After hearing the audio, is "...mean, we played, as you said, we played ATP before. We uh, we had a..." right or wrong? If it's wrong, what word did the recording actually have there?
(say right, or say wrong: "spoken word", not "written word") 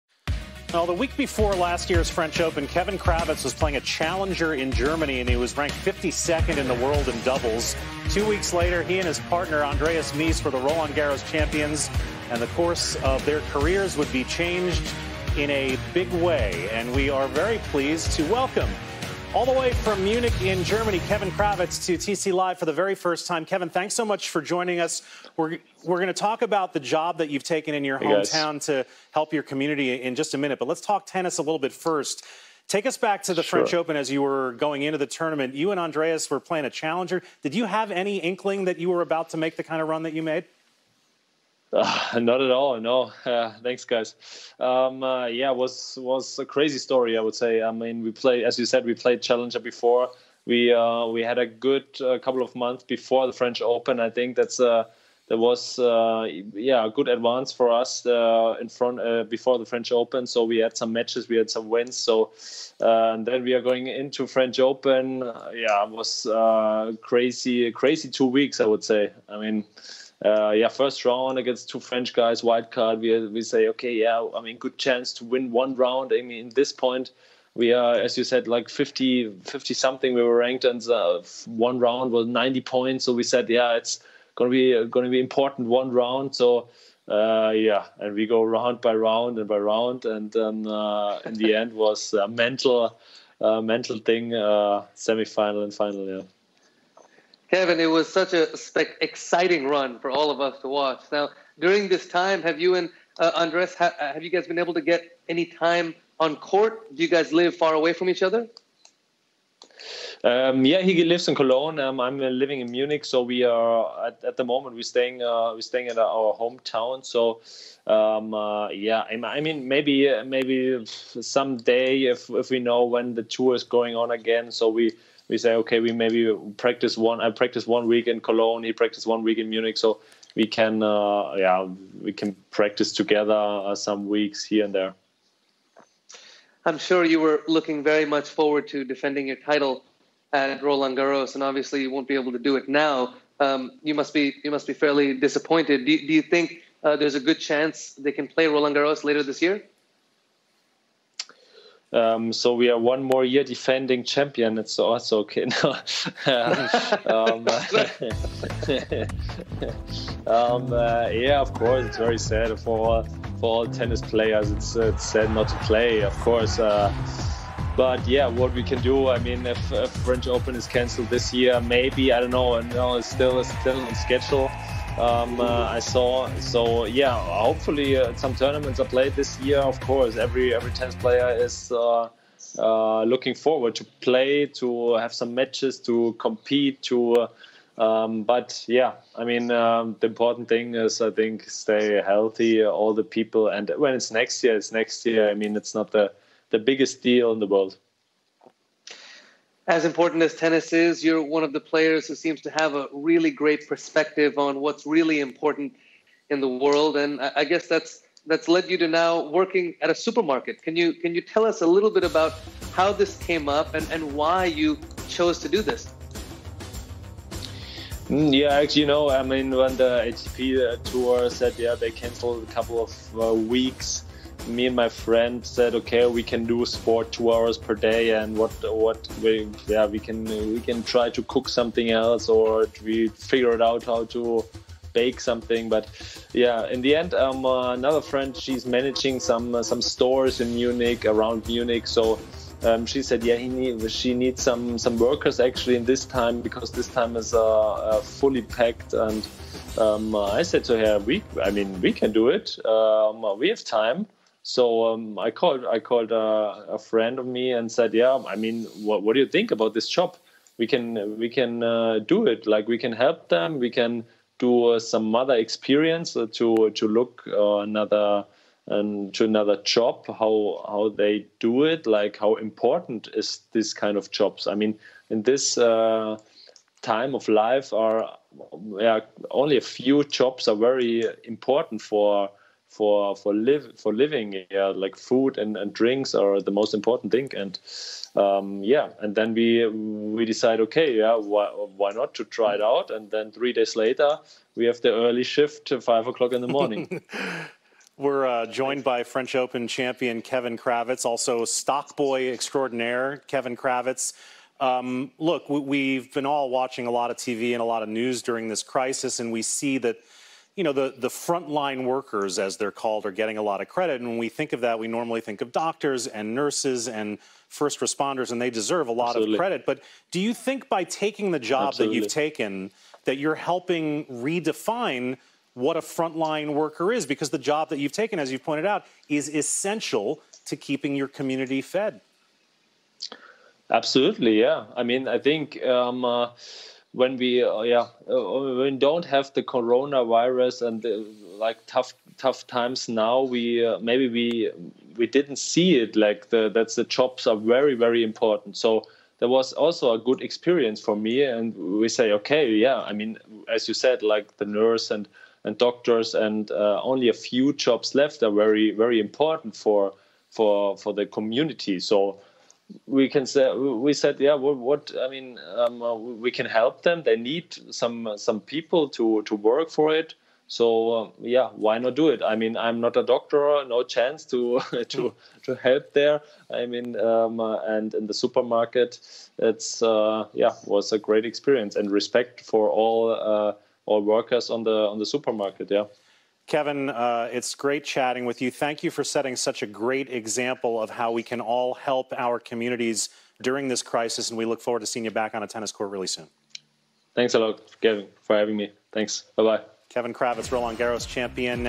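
wrong: "Challenger", not "ATP".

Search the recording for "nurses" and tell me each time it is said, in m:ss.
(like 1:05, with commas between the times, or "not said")
5:16, 5:54.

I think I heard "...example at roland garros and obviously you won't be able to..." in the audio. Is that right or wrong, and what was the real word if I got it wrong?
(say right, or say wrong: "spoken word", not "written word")
wrong: "title", not "example".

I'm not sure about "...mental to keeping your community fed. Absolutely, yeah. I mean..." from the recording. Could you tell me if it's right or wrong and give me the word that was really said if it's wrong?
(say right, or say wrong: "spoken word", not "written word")
wrong: "essential", not "mental".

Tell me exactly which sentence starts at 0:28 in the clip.
to help your community in just a minute, but let's talk tennis a little bit first.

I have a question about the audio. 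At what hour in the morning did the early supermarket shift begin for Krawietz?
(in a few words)
5.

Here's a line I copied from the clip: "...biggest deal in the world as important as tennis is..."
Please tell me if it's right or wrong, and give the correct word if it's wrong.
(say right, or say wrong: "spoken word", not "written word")
right.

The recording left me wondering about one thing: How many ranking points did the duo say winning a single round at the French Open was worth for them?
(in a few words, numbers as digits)
90.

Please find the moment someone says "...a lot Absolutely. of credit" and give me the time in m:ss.
5:18.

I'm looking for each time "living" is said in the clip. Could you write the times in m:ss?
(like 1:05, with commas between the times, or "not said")
1:52, 4:43.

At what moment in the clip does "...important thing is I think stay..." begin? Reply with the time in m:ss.
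3:10.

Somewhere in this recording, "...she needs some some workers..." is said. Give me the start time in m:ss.
4:03.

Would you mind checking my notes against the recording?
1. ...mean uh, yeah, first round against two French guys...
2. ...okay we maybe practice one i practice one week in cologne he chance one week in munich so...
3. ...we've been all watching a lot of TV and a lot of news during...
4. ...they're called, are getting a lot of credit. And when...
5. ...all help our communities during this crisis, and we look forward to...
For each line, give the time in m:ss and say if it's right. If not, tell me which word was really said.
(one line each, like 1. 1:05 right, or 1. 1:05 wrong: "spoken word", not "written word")
1. 1:09 right
2. 2:05 wrong: "practice", not "chance"
3. 5:05 right
4. 5:12 right
5. 6:31 right.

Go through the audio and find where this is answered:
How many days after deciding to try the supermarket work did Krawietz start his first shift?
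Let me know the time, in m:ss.
4:53.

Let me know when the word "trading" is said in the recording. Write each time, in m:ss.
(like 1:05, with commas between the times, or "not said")
not said.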